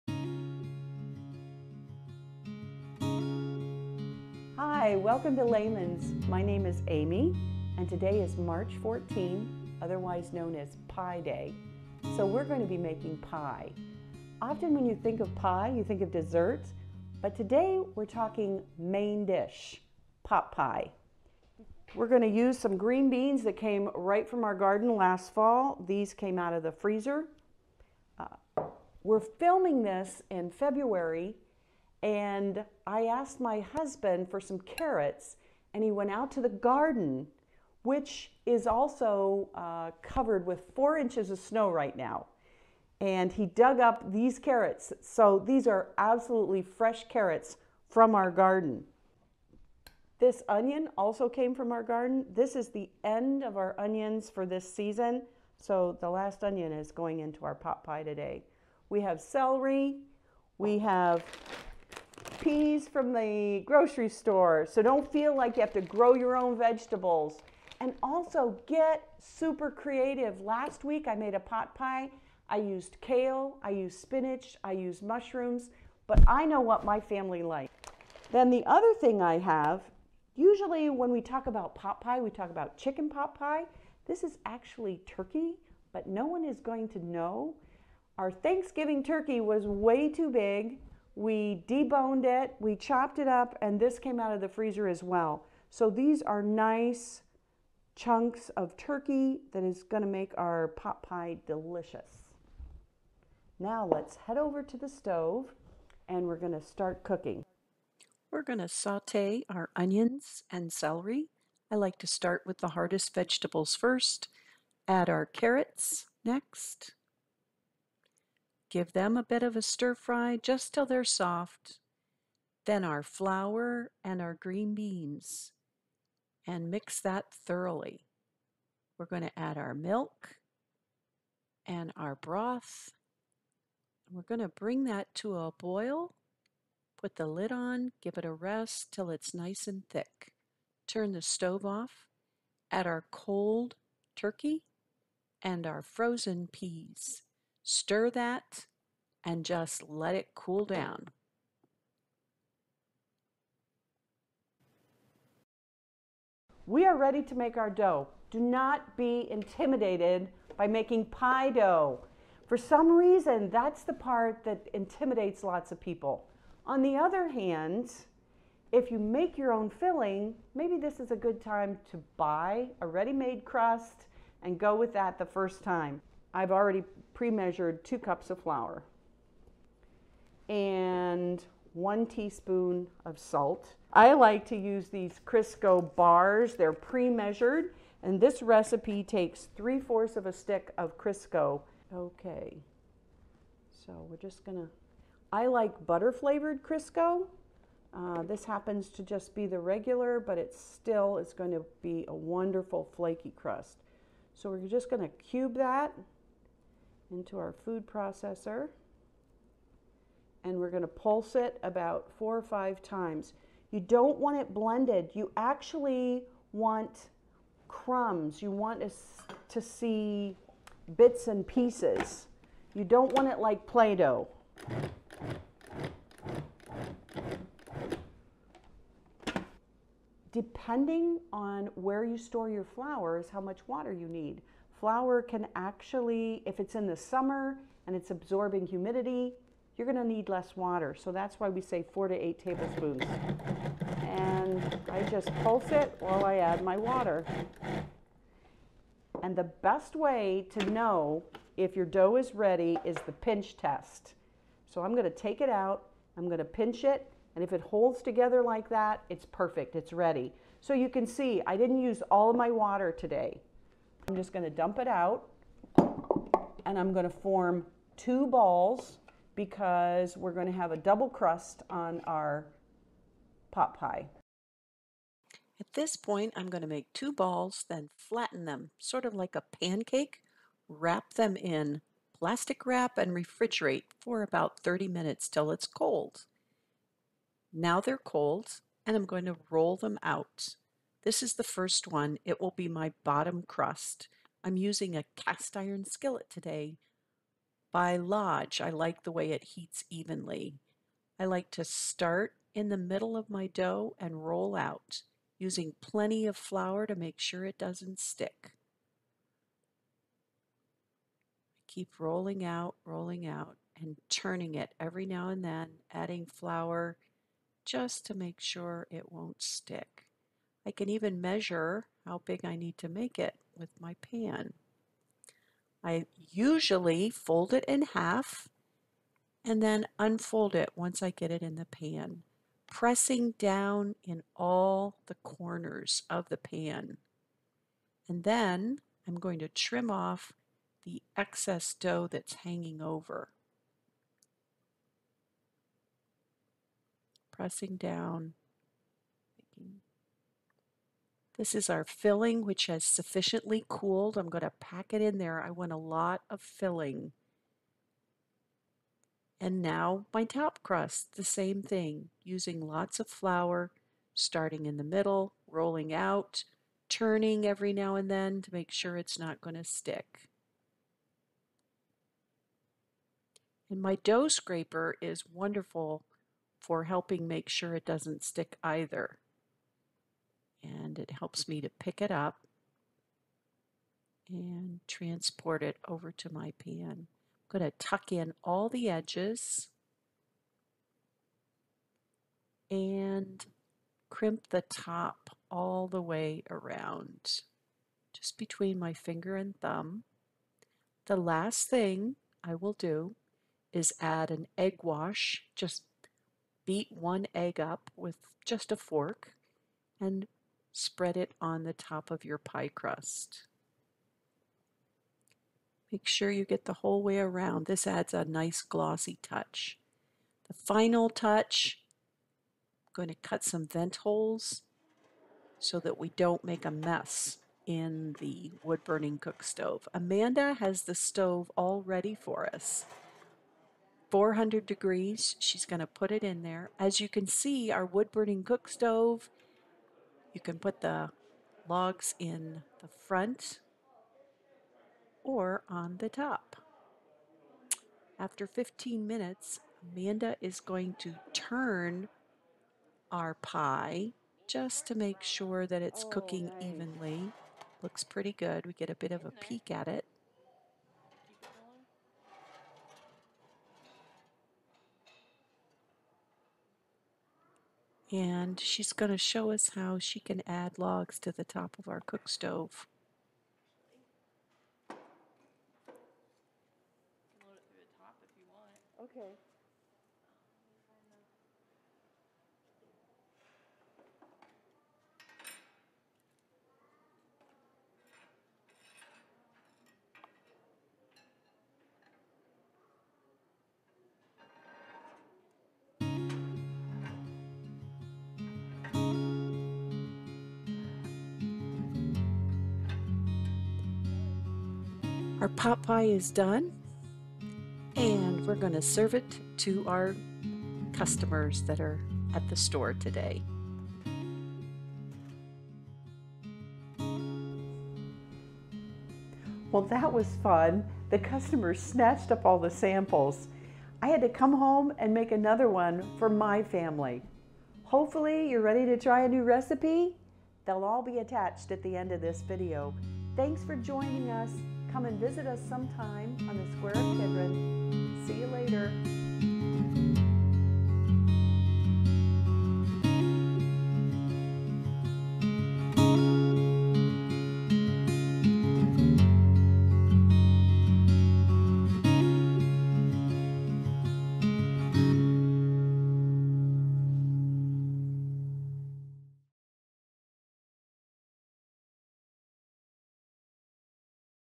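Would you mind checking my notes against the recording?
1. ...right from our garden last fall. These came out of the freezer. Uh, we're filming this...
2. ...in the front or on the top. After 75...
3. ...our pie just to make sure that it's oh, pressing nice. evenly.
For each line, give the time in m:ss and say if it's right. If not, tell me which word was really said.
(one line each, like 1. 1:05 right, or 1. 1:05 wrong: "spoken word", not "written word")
1. 0:23 right
2. 7:22 wrong: "15", not "75"
3. 7:33 wrong: "cooking", not "pressing".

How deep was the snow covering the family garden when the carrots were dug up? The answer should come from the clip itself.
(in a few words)
4 inches.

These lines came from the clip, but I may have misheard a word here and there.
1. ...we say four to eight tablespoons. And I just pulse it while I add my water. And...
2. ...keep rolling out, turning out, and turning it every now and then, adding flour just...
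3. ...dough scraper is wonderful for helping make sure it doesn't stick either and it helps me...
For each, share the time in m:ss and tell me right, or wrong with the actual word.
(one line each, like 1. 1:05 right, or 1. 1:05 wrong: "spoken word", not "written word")
1. 4:01 right
2. 5:11 wrong: "rolling", not "turning"
3. 6:13 right.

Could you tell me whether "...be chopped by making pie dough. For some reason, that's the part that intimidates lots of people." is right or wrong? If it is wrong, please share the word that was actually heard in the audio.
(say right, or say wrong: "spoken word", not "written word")
wrong: "intimidated", not "chopped".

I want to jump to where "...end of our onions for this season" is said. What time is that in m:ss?
0:53.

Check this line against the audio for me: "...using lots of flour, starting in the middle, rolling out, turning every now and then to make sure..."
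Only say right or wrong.
right.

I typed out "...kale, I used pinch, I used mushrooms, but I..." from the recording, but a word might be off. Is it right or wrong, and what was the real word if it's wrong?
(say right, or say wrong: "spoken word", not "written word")
wrong: "spinach", not "pinch".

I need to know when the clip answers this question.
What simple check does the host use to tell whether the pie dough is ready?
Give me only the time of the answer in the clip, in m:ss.
4:13.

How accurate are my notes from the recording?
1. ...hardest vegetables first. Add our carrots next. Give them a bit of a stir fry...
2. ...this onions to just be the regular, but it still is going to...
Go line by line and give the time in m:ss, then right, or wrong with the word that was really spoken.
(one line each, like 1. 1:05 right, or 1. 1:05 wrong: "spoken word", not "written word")
1. 1:52 right
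2. 3:18 wrong: "happens", not "onions".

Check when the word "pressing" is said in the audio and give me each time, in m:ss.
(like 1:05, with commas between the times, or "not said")
5:32, 5:47.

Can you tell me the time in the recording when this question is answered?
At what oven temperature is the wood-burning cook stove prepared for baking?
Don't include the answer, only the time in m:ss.
7:14.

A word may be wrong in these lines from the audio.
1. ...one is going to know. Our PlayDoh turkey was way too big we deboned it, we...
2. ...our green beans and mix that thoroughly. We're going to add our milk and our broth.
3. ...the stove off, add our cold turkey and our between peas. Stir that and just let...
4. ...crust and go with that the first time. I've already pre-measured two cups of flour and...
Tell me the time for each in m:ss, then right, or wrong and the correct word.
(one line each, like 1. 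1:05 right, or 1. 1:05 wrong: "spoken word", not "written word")
1. 1:26 wrong: "Thanksgiving", not "PlayDoh"
2. 2:04 right
3. 2:21 wrong: "frozen", not "between"
4. 2:53 right.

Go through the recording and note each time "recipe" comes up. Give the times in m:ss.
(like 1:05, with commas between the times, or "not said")
3:08, 8:49.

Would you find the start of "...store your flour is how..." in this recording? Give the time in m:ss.
3:52.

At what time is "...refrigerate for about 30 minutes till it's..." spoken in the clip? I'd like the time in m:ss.
4:43.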